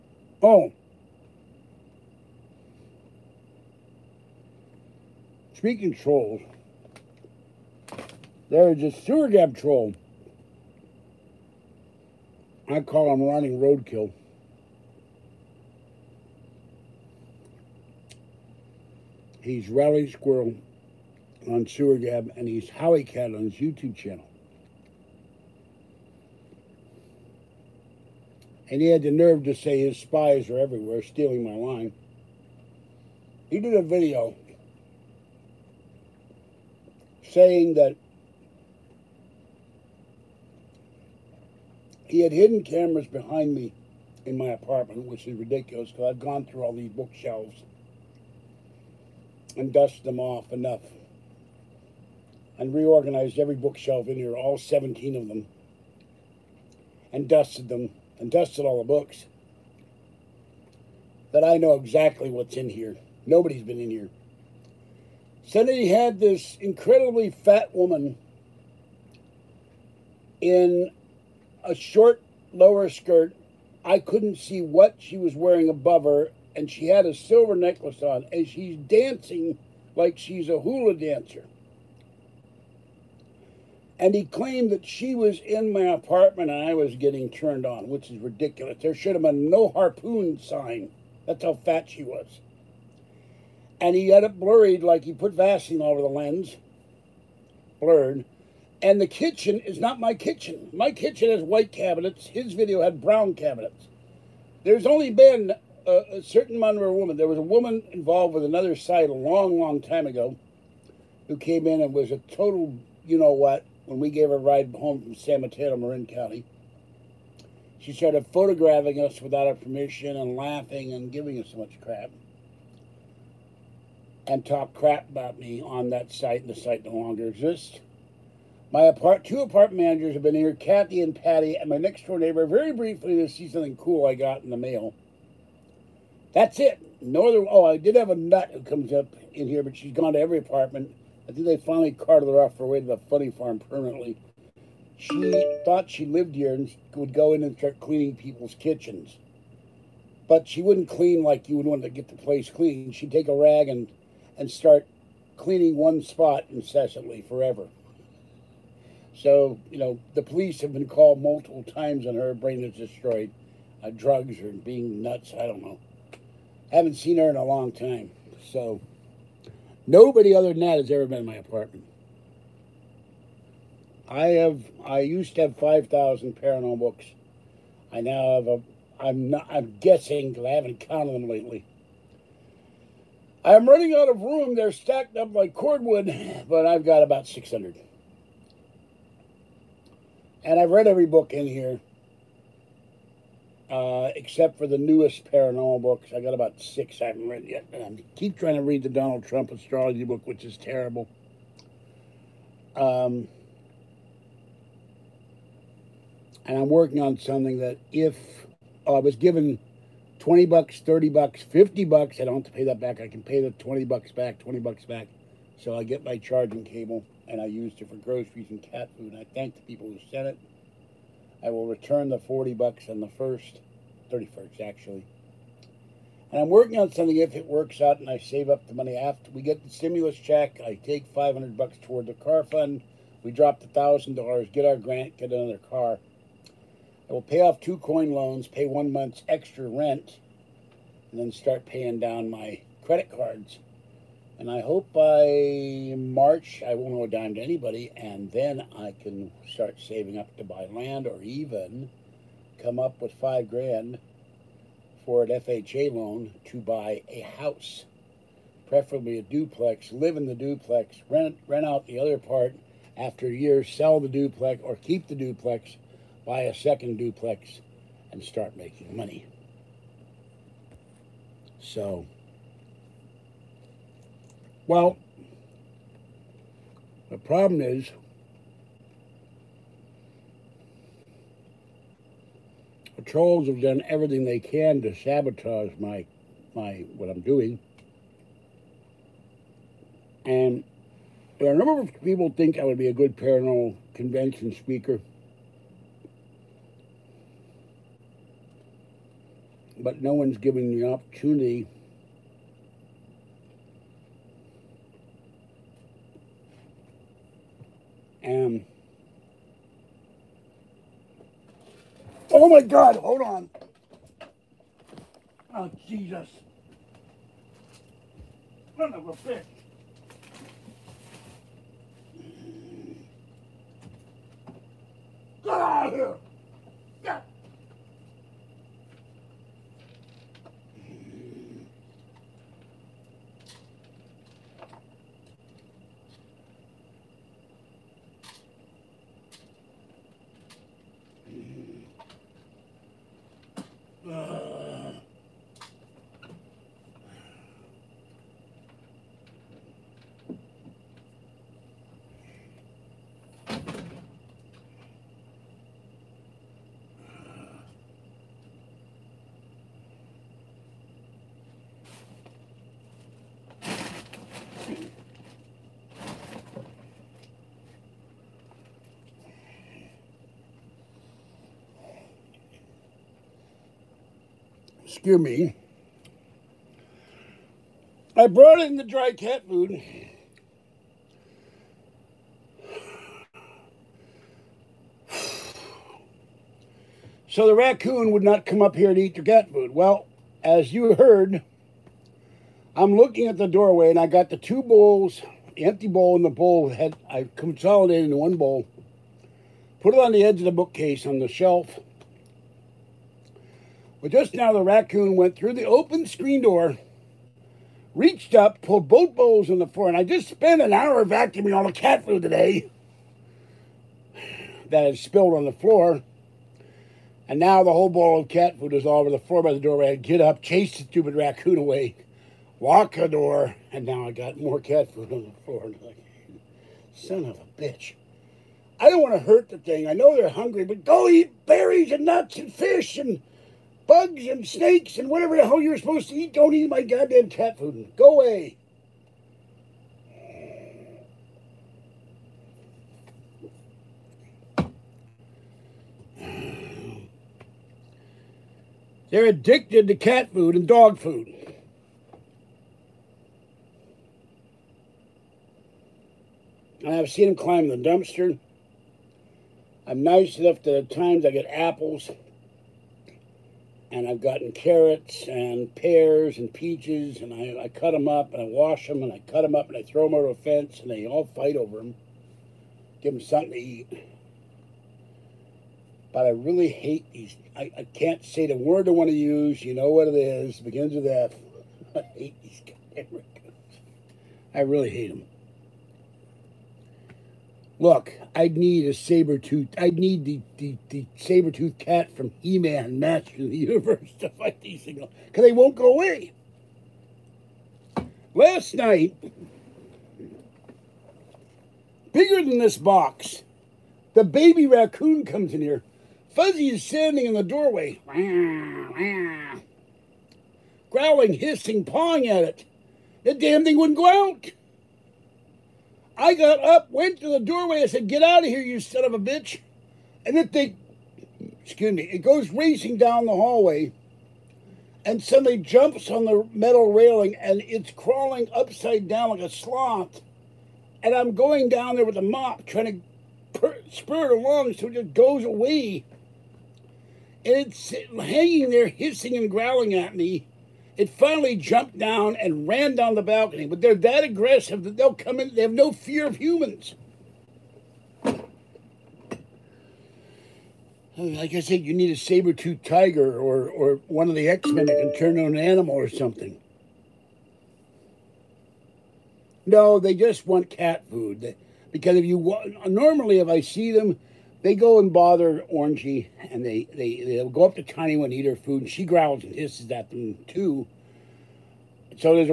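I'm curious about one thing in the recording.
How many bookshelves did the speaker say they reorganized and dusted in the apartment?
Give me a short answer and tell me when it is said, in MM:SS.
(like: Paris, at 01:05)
17, at 00:54.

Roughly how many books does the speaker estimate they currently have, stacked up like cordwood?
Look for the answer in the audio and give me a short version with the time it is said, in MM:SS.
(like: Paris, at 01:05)
About 600, at 03:07.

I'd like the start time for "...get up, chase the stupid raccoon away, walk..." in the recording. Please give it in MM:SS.
06:59.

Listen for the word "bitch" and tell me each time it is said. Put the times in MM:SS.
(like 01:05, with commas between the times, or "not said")
05:19, 07:07, 08:39.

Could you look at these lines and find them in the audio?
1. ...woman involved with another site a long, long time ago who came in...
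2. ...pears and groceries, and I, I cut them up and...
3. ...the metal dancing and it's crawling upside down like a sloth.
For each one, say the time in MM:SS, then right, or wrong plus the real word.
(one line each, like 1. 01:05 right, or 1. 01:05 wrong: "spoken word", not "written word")
1. 01:47 right
2. 07:45 wrong: "peaches", not "groceries"
3. 08:46 wrong: "railing", not "dancing".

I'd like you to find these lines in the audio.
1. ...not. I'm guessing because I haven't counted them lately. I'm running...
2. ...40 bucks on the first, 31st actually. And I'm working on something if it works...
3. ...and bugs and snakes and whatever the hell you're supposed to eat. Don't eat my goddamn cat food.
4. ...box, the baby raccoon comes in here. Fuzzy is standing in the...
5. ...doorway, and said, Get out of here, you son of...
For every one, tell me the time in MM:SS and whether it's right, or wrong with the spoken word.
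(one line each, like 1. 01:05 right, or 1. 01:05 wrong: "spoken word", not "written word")
1. 02:59 right
2. 03:42 right
3. 07:12 right
4. 08:22 right
5. 08:37 right.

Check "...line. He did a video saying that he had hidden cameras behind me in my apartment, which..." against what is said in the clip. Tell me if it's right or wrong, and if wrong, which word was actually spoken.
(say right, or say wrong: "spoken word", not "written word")
right.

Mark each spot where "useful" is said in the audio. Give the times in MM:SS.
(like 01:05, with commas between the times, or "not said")
not said.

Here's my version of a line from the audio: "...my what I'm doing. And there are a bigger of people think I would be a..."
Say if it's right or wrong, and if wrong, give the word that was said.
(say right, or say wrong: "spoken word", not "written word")
wrong: "number", not "bigger".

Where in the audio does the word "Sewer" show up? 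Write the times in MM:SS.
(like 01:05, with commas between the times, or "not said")
00:08, 00:21.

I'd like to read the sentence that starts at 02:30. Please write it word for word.
But she wouldn't clean like you would want to get the place clean.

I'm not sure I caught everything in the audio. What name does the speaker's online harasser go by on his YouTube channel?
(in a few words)
Howie Cat.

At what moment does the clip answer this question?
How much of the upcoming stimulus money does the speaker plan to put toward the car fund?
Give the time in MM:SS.
03:51.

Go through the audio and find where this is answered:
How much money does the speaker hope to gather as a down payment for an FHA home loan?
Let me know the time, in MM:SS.
04:13.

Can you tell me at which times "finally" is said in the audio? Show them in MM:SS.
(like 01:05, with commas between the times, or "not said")
02:21, 09:01.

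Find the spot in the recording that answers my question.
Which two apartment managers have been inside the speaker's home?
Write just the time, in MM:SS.
02:10.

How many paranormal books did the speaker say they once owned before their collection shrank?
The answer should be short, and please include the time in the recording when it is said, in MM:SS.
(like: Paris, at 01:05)
5,000, at 02:55.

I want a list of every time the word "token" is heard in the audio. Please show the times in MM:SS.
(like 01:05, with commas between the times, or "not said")
not said.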